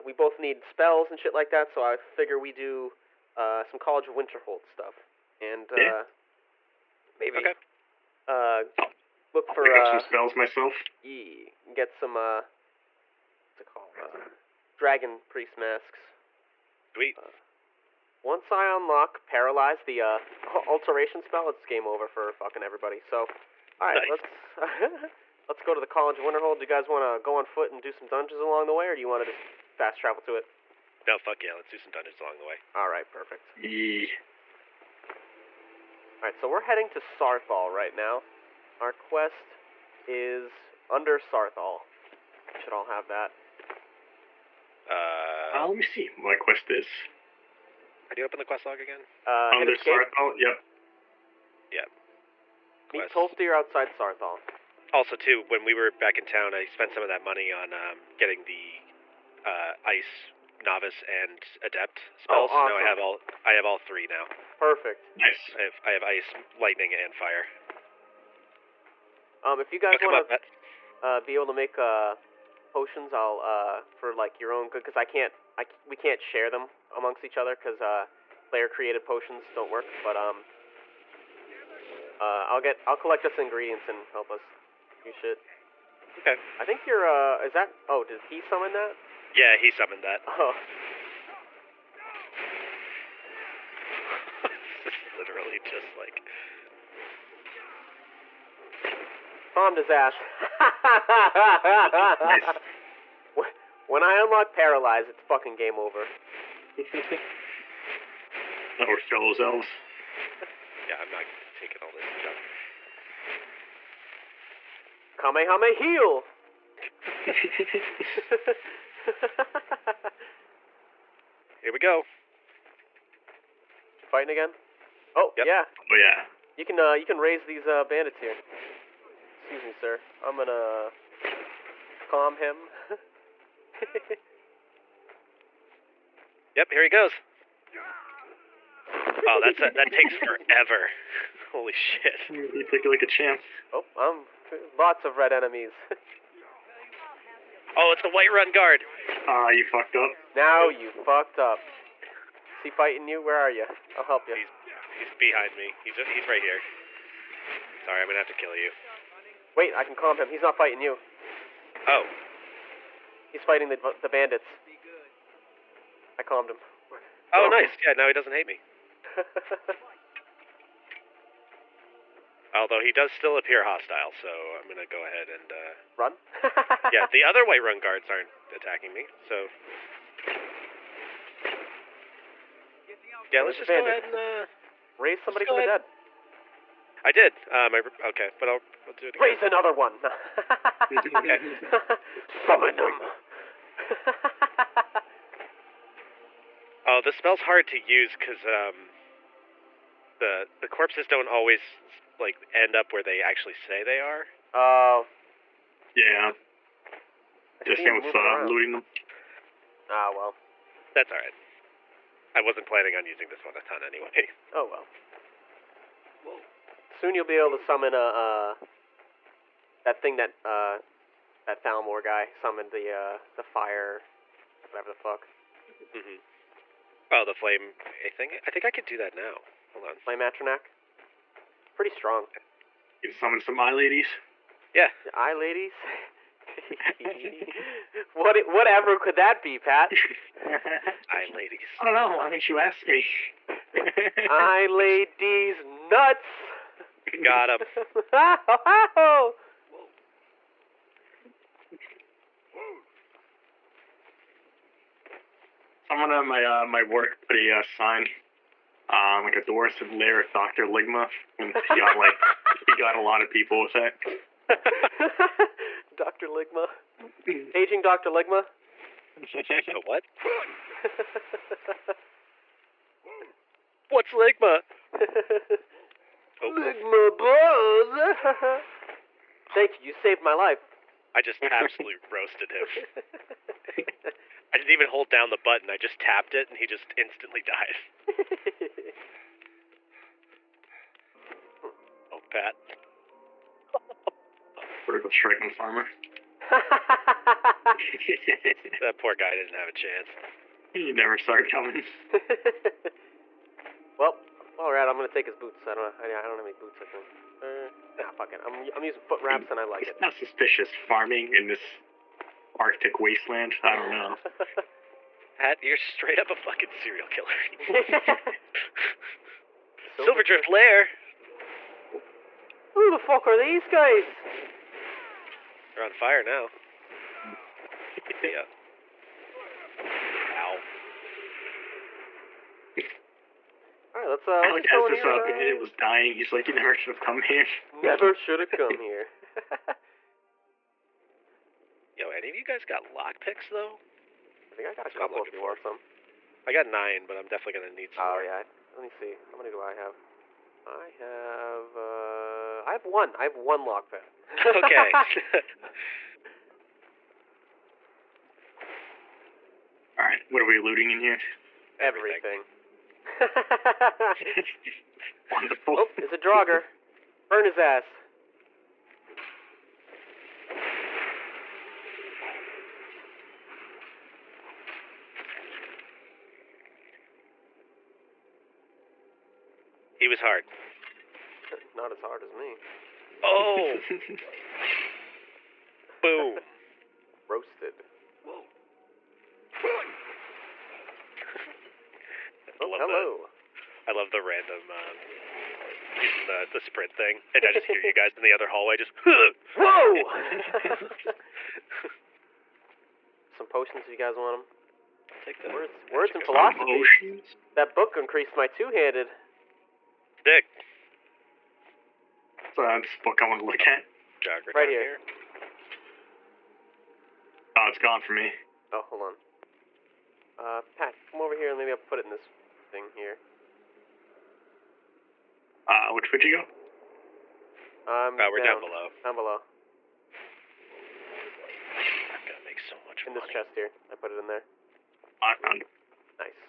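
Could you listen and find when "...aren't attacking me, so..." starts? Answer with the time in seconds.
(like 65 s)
178 s.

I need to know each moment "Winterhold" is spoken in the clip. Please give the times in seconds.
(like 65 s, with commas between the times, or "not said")
4 s, 26 s.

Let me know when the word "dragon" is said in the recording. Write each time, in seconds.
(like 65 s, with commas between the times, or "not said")
14 s.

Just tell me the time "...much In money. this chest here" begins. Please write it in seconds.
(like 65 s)
432 s.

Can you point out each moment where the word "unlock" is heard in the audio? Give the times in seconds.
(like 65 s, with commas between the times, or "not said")
18 s, 104 s.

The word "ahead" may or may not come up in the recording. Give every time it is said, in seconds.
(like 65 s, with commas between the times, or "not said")
174 s, 183 s.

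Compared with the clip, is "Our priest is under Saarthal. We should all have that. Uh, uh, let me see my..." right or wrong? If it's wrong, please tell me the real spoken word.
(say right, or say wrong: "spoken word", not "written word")
wrong: "quest", not "priest".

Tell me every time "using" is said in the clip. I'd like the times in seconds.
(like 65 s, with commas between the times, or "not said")
213 s, 308 s.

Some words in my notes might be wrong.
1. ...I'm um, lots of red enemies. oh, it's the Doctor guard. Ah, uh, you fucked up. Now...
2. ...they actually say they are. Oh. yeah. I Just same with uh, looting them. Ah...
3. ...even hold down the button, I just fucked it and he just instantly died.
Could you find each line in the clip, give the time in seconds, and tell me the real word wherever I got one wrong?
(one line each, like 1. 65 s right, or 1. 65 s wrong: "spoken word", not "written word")
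1. 143 s wrong: "Whiterun", not "Doctor"
2. 203 s right
3. 284 s wrong: "tapped", not "fucked".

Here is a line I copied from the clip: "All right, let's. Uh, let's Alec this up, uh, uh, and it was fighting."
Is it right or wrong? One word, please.
wrong.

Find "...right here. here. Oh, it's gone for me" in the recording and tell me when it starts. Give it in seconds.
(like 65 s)
414 s.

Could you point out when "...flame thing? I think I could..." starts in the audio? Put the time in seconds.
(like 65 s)
227 s.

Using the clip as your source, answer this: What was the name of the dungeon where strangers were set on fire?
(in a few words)
Silverdrift Lair.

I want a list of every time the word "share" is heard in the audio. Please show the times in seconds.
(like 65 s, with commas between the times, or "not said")
76 s.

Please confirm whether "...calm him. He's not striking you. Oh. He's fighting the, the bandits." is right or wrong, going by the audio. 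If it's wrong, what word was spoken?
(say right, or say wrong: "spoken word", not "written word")
wrong: "fighting", not "striking".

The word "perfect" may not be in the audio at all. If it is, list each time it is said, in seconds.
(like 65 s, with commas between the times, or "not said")
33 s, 64 s.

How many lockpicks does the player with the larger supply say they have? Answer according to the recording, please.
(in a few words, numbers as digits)
9.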